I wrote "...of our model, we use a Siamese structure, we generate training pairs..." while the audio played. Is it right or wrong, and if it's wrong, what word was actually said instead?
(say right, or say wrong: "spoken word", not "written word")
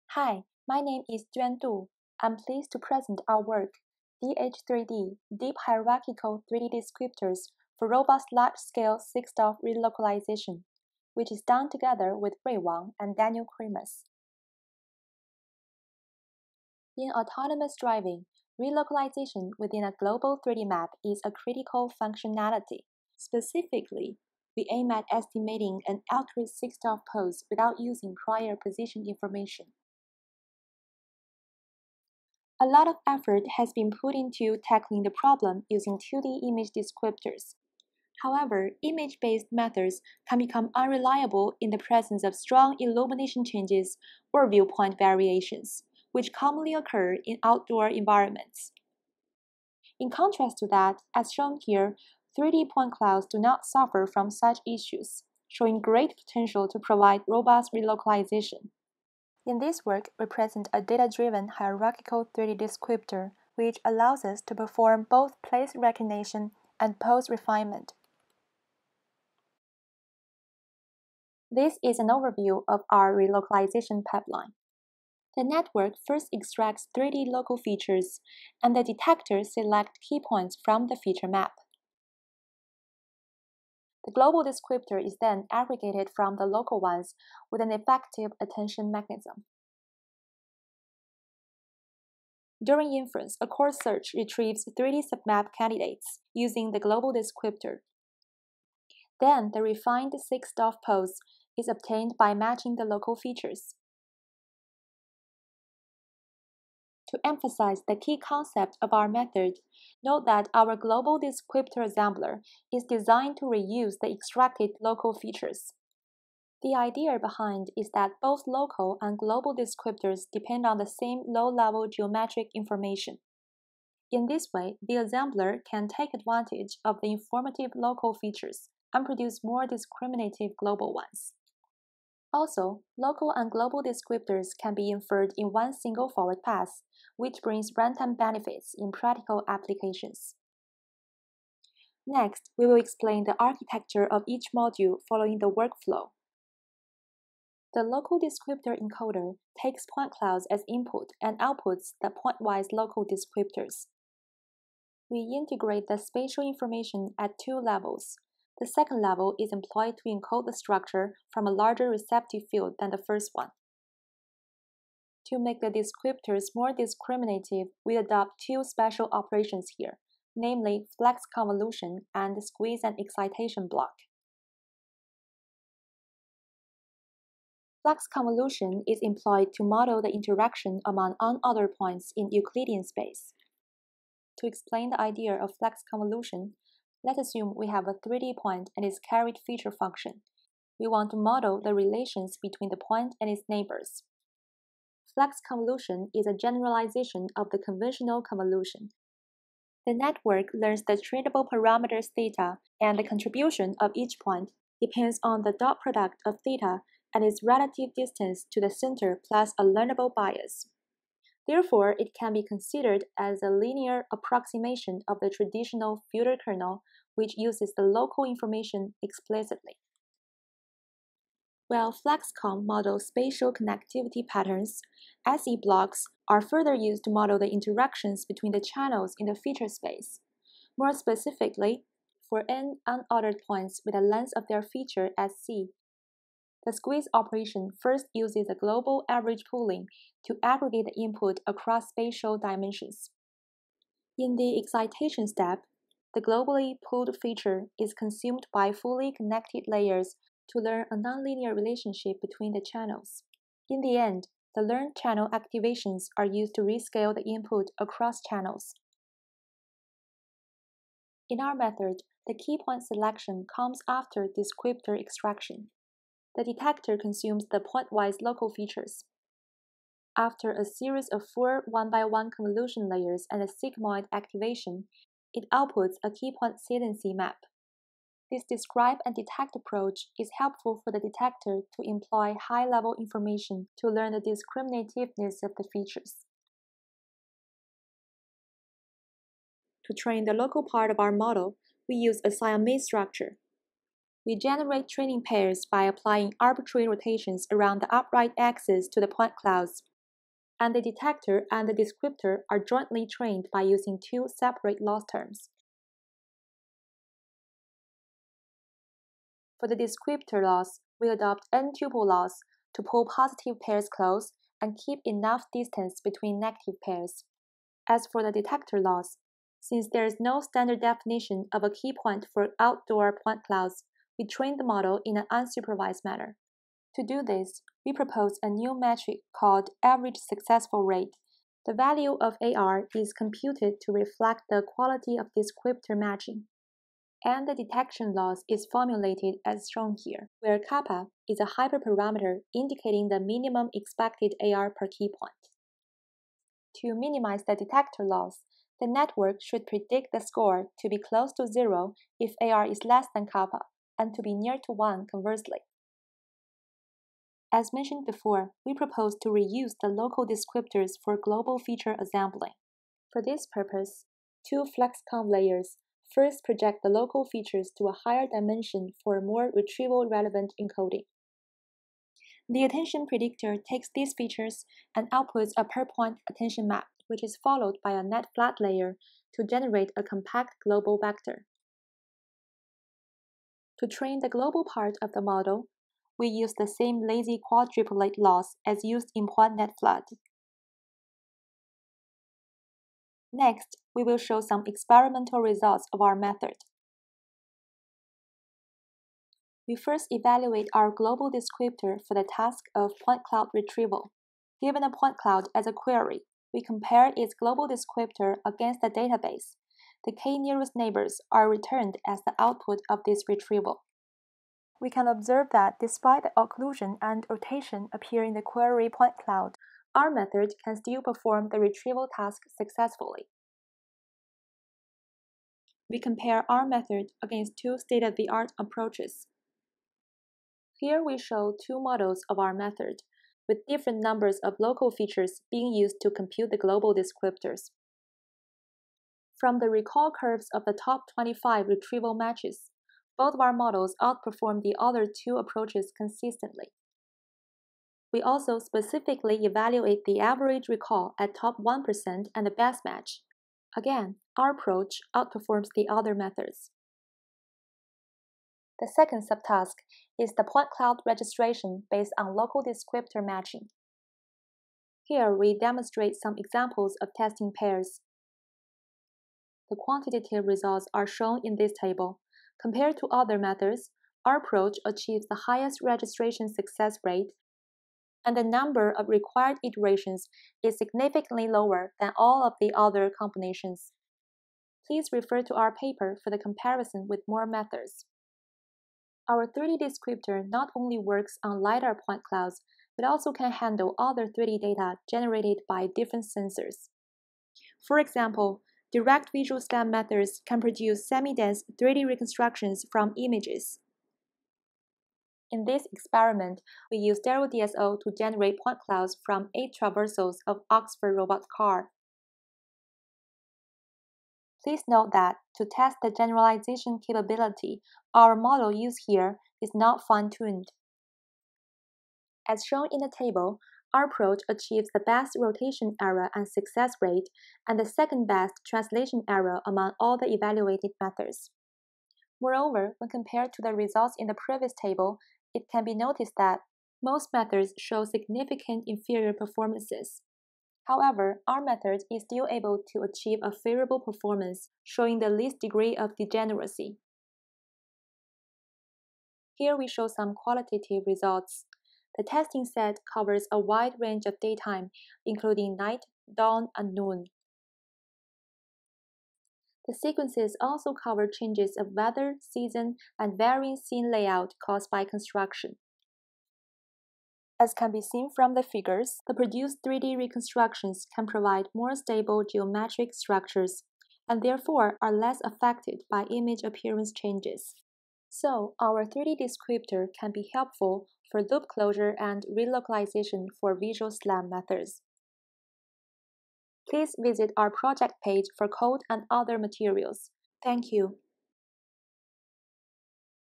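right.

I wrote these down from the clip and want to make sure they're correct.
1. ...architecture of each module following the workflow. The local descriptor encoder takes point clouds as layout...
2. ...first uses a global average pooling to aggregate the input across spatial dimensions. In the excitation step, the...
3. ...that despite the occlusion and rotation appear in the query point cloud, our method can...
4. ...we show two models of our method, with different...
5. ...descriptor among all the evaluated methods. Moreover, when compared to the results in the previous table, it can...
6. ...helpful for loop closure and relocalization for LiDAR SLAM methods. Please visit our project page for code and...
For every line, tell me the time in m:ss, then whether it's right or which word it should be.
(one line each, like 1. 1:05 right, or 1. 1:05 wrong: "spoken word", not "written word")
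1. 2:23 wrong: "input", not "layout"
2. 3:57 right
3. 6:55 right
4. 7:11 right
5. 8:49 wrong: "error", not "descriptor"
6. 9:40 wrong: "Visual", not "LiDAR".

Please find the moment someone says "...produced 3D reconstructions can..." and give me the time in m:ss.
9:29.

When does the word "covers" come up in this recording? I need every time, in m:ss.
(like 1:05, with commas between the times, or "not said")
9:13, 9:20.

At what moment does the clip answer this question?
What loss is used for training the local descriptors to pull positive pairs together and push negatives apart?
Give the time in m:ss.
5:11.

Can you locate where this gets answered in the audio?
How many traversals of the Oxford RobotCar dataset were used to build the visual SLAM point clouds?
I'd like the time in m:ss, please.
8:29.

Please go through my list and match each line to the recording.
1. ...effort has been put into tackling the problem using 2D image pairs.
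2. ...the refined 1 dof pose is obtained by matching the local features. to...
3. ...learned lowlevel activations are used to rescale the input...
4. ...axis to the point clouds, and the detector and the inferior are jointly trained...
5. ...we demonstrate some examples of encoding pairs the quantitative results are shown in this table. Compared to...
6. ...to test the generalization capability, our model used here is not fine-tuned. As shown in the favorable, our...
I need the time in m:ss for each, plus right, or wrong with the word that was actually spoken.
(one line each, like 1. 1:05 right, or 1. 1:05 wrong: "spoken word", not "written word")
1. 0:33 wrong: "descriptors", not "pairs"
2. 1:39 wrong: "6", not "1"
3. 4:14 wrong: "channel", not "lowlevel"
4. 4:58 wrong: "descriptor", not "inferior"
5. 7:45 wrong: "testing", not "encoding"
6. 8:35 wrong: "table", not "favorable".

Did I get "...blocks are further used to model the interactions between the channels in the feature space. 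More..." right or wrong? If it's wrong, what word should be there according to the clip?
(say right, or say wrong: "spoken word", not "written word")
right.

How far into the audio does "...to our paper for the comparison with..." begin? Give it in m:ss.
8:05.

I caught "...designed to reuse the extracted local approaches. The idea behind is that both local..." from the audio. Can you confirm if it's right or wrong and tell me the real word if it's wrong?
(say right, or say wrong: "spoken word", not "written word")
wrong: "features", not "approaches".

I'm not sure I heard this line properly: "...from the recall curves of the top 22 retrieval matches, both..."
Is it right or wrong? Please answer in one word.
wrong.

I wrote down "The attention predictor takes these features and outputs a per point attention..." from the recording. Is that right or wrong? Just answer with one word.
right.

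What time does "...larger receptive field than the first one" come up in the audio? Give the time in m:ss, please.
2:41.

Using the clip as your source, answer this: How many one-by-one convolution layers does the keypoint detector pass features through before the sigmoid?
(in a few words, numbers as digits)
4.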